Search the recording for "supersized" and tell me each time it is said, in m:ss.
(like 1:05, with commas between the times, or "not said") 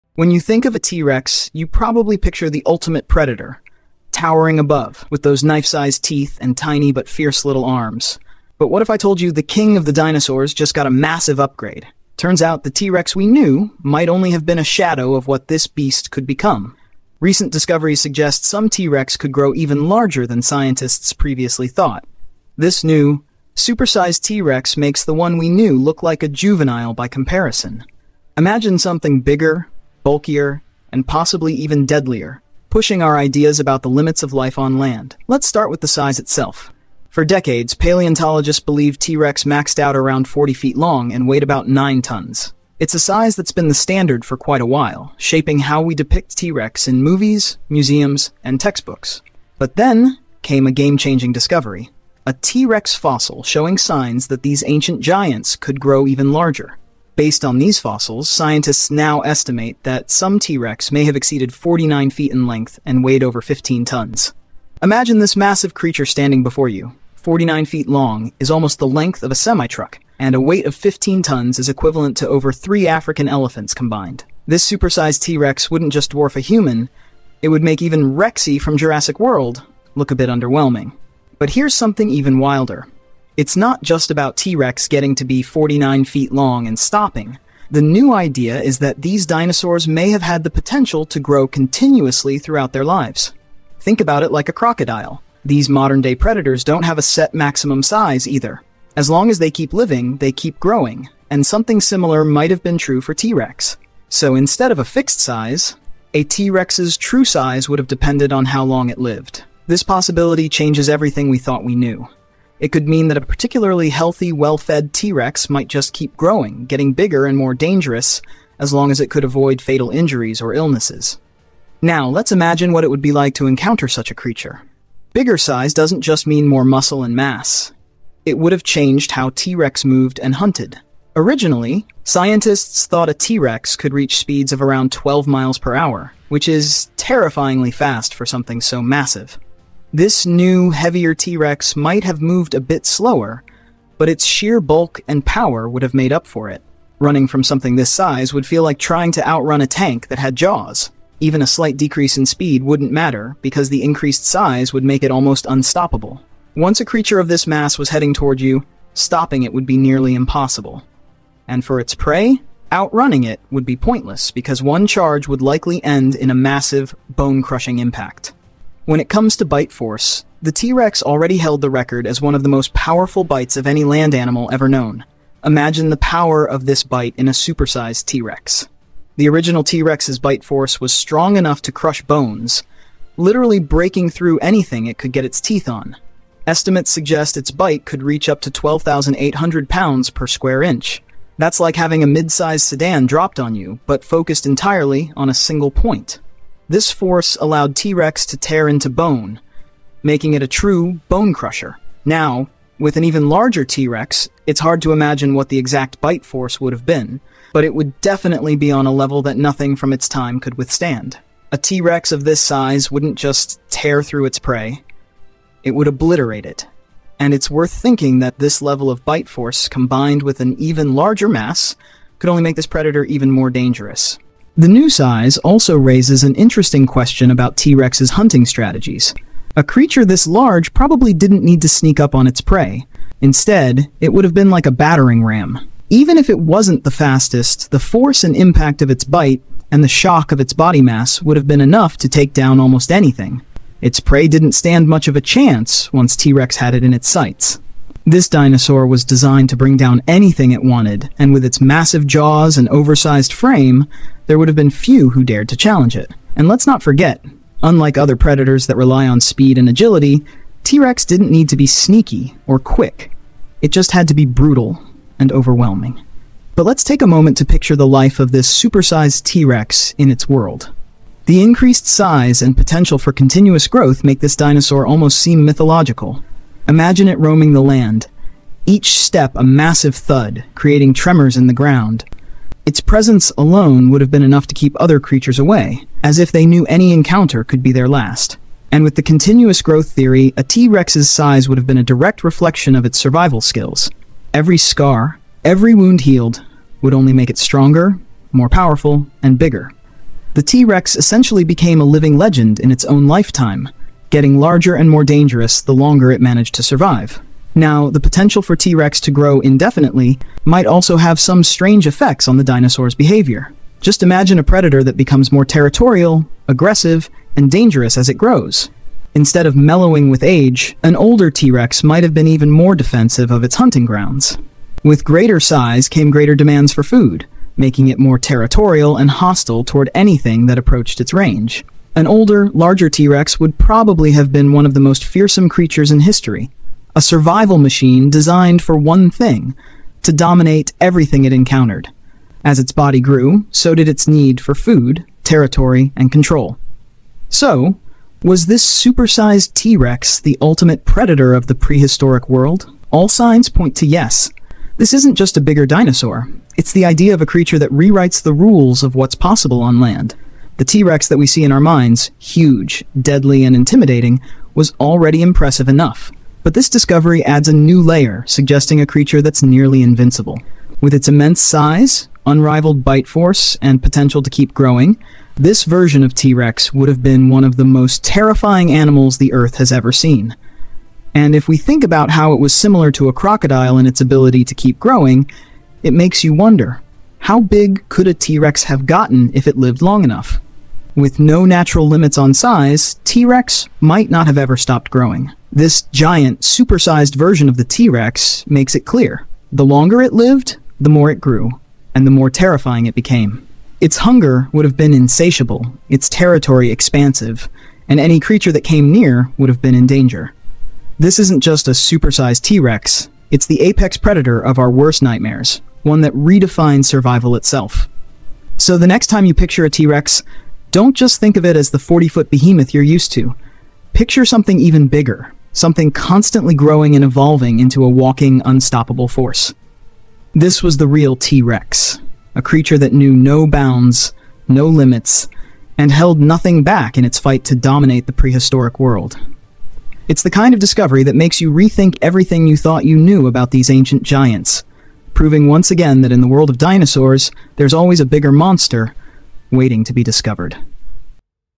0:23, 1:14, 2:57, 4:28, 5:48, 6:36, 6:51.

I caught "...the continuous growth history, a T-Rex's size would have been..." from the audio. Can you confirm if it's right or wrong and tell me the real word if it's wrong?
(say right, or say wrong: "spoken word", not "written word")
wrong: "theory", not "history".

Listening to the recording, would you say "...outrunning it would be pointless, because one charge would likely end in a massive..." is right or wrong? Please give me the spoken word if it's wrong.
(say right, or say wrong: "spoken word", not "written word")
right.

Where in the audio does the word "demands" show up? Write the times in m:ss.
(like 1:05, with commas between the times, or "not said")
5:26.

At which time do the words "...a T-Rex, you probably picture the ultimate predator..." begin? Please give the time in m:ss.
0:00.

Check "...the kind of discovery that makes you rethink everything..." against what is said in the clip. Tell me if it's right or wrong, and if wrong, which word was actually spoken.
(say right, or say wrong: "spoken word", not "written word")
right.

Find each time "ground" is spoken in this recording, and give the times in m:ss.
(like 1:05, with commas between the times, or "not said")
4:41, 5:23.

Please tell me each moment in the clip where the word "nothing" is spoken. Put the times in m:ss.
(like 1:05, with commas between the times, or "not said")
3:29, 7:16.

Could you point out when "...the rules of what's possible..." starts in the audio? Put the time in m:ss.
5:58.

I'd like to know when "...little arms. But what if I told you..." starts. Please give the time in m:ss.
0:07.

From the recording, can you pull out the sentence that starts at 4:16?
And let's not forget, unlike other predators that rely on speed and agility, T-Rex didn't need to be sneaky or quick.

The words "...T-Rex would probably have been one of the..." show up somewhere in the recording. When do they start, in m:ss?
5:32.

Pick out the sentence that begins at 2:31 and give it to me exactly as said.
Even a slight decrease in speed wouldn't matter, because the increased size would make it almost unstoppable.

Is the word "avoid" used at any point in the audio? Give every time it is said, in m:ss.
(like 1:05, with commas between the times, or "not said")
1:59.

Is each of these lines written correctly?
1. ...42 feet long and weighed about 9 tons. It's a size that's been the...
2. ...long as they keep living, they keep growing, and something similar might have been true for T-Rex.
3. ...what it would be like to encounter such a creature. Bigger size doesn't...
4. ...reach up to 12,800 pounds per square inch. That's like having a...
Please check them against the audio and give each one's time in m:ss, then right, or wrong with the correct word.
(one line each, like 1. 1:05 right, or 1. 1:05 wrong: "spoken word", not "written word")
1. 0:40 wrong: "40", not "42"
2. 1:39 right
3. 2:02 right
4. 3:08 right.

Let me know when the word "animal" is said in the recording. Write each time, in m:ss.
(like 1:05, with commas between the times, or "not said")
2:54, 6:18.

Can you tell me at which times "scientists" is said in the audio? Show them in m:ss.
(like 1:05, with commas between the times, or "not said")
0:20, 0:58, 2:12.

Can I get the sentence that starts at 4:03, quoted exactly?
Its prey didn't stand much of a chance once T-Rex had it in its sights.